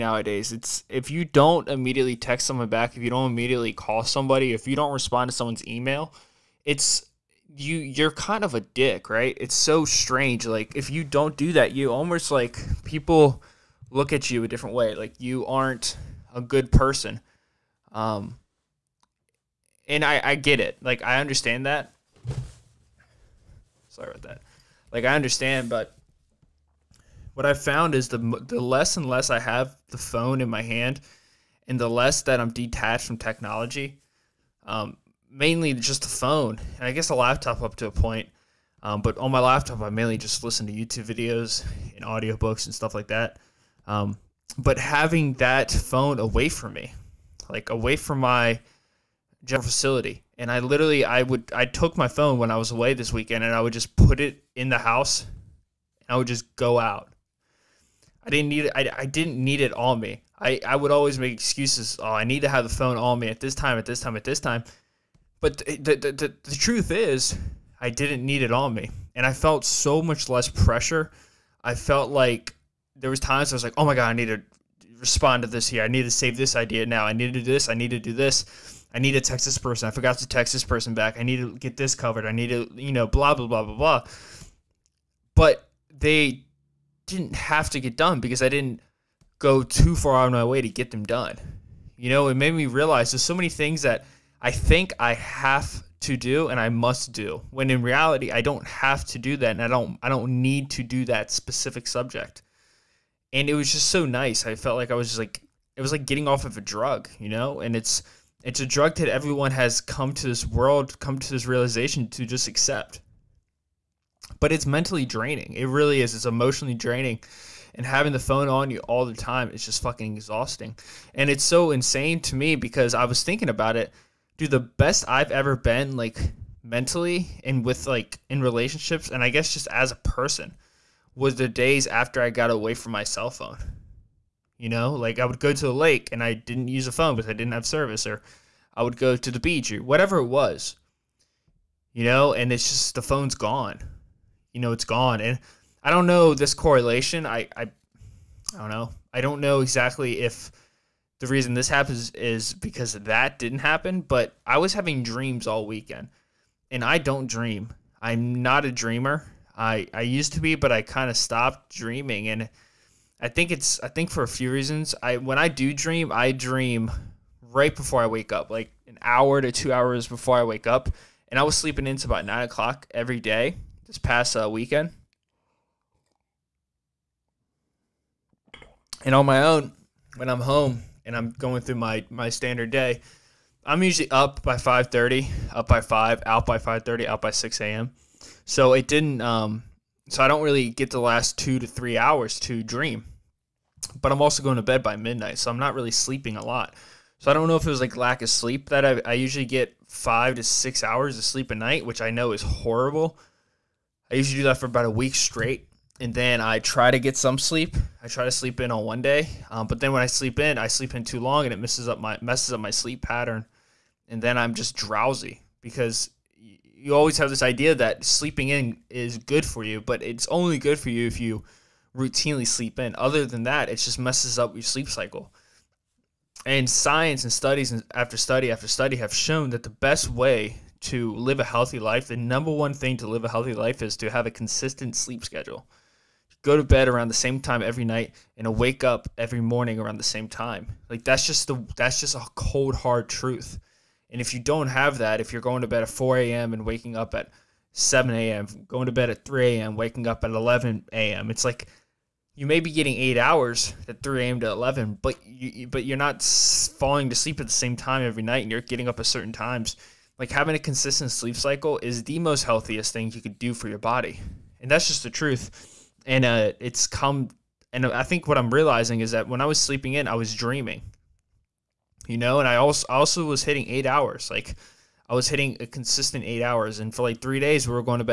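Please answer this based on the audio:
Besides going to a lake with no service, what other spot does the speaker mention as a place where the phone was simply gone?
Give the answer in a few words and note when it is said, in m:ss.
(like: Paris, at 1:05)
the beach, at 2:19.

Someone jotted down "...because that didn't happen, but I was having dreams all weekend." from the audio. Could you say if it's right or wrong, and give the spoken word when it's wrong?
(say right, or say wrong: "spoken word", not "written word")
right.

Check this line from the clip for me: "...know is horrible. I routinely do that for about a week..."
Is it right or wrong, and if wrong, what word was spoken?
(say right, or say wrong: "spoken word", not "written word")
wrong: "usually", not "routinely".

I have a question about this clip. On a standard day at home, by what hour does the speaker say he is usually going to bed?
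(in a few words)
midnight.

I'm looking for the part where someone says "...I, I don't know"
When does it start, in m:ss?
2:27.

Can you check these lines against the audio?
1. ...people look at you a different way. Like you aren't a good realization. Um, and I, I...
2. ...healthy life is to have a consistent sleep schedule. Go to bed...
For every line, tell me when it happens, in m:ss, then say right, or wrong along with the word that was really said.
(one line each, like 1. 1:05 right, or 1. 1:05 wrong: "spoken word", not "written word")
1. 0:12 wrong: "person", not "realization"
2. 3:53 right.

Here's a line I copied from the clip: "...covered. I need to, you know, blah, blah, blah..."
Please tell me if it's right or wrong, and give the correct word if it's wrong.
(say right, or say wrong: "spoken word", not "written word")
right.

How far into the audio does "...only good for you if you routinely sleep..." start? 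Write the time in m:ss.
3:40.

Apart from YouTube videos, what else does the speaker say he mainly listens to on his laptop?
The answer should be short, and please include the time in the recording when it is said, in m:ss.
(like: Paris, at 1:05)
audiobooks, at 0:42.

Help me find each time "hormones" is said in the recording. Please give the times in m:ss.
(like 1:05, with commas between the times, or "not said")
not said.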